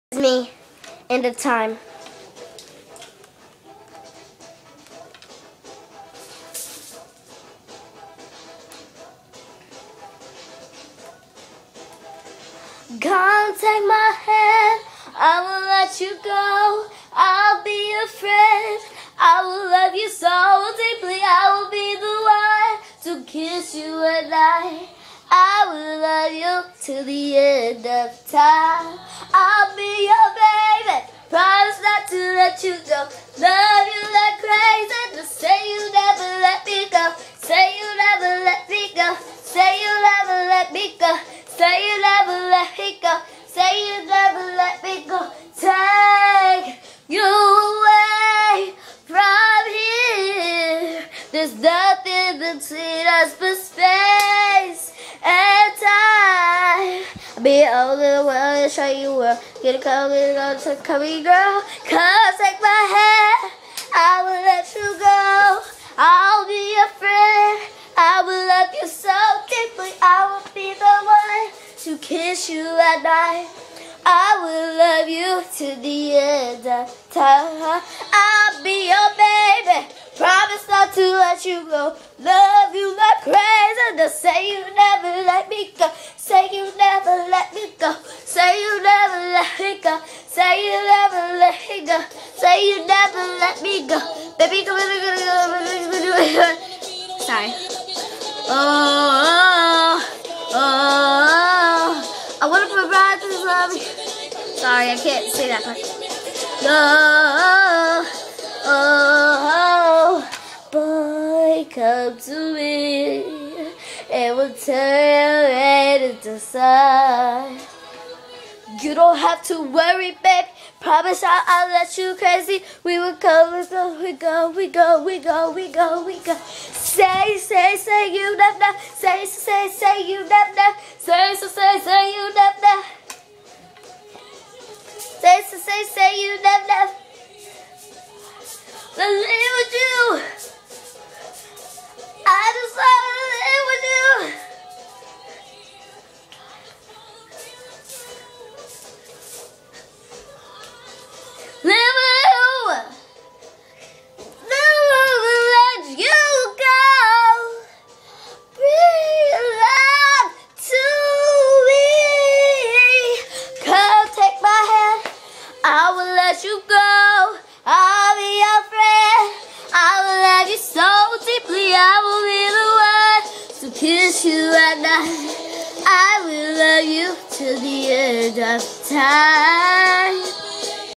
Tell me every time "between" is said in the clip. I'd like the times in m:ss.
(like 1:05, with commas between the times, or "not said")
0:52.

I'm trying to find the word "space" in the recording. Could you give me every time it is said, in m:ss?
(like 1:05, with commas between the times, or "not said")
0:53.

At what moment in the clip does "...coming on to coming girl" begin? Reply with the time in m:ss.
0:59.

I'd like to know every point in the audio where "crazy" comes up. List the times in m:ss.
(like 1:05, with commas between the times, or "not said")
0:34, 1:23, 2:02.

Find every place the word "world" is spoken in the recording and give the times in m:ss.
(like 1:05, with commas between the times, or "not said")
0:58.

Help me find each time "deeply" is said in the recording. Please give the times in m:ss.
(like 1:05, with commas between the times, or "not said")
0:20, 1:09.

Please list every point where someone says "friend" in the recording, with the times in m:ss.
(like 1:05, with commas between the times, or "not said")
0:18, 1:07.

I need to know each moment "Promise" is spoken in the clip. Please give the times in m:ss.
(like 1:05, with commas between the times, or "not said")
0:31, 1:20, 2:00.